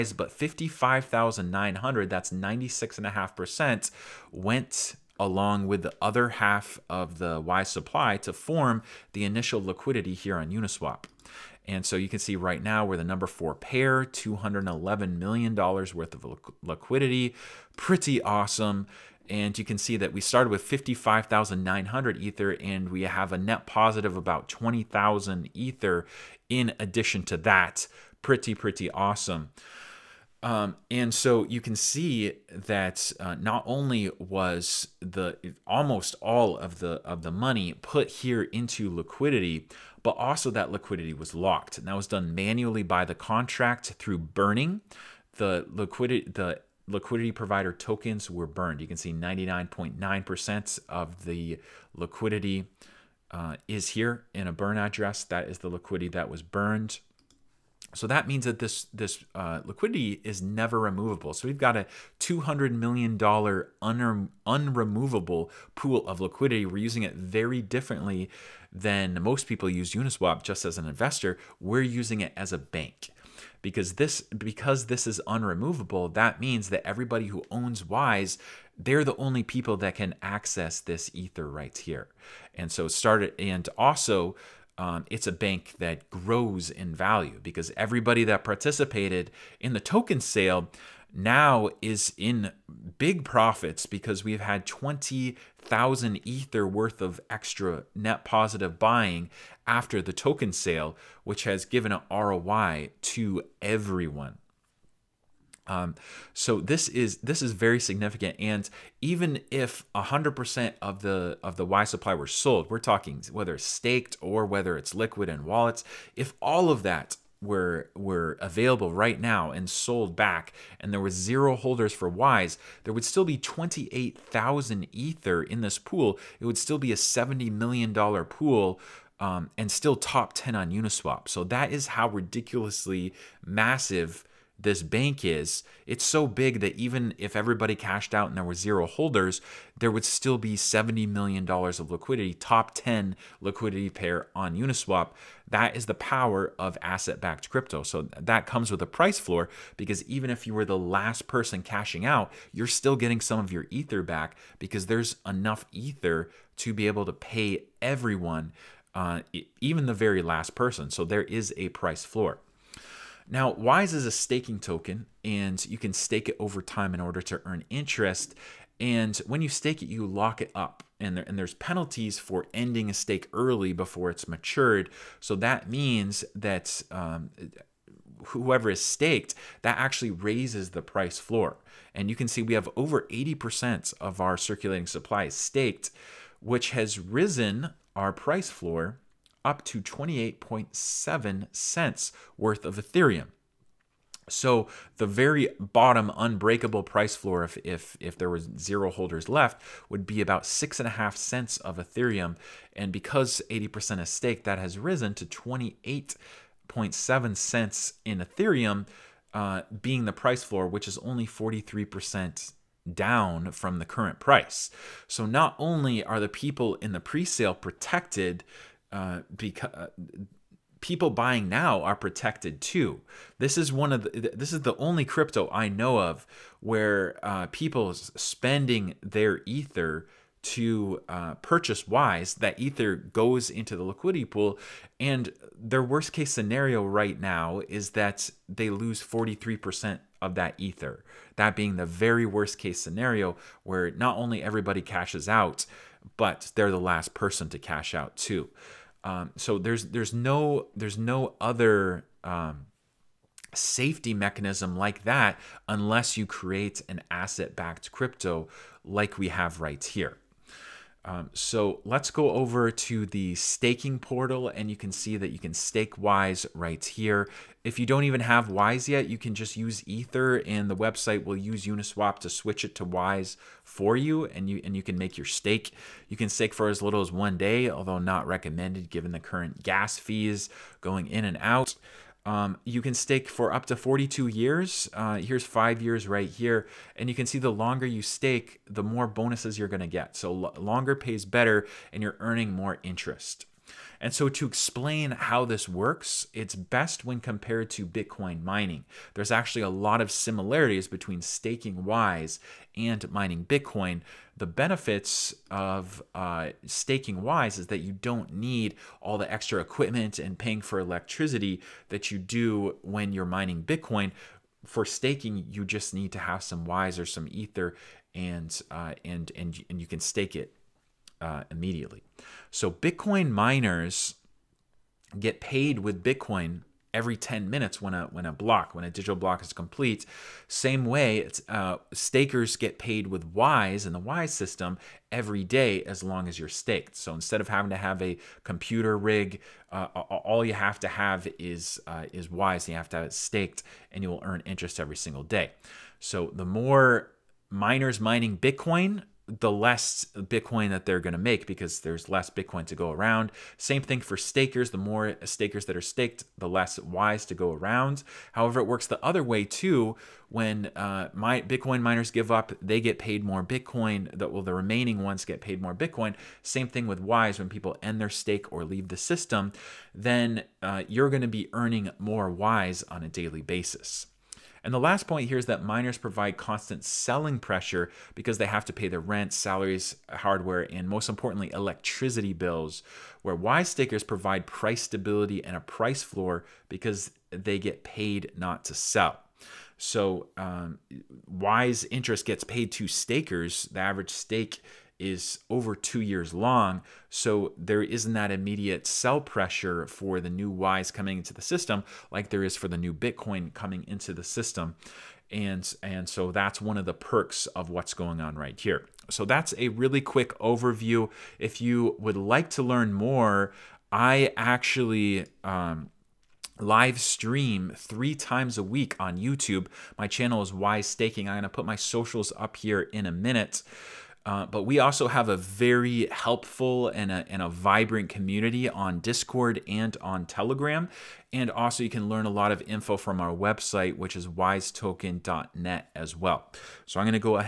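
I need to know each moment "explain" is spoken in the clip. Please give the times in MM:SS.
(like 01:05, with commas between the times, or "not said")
04:54.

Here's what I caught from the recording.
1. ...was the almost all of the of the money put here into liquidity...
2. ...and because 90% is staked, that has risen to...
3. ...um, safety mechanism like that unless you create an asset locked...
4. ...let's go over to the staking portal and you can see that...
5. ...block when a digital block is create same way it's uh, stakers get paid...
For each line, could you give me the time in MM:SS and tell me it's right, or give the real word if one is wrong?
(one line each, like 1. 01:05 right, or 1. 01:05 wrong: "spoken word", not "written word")
1. 00:34 right
2. 03:22 wrong: "80", not "90"
3. 04:12 wrong: "backed", not "locked"
4. 04:21 right
5. 05:28 wrong: "complete", not "create".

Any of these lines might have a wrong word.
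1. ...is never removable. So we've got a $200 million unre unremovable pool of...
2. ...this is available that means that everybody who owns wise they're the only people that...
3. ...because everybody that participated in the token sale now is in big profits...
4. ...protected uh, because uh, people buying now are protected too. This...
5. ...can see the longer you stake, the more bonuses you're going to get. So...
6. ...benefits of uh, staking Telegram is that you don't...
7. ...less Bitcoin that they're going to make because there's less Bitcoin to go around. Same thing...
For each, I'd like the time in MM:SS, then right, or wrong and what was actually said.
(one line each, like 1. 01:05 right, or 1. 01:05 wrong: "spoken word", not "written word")
1. 01:00 right
2. 01:14 wrong: "unremovable", not "available"
3. 01:27 right
4. 03:37 right
5. 04:47 right
6. 05:04 wrong: "Wise", not "Telegram"
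7. 05:49 right.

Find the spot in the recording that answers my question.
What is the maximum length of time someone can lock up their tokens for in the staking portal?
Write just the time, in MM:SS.
04:43.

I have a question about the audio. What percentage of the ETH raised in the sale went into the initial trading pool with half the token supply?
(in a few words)
96.5%.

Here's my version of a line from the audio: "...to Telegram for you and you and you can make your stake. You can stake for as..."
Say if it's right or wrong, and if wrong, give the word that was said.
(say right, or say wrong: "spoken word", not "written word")
wrong: "Wise", not "Telegram".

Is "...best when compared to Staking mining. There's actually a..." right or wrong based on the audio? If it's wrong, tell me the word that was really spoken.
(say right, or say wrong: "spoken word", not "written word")
wrong: "Bitcoin", not "Staking".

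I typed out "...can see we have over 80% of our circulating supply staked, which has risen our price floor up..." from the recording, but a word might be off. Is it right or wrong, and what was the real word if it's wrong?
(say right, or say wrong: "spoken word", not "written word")
right.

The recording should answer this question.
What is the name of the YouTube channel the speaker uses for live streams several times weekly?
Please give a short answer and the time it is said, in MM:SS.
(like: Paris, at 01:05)
Wise Staking, at 07:00.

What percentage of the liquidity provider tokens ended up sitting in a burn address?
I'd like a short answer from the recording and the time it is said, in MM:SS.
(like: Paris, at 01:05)
99.9%, at 00:49.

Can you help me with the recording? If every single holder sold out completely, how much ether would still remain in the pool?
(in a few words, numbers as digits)
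28,000 ether.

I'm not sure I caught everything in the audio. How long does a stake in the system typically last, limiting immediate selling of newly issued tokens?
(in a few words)
over two years.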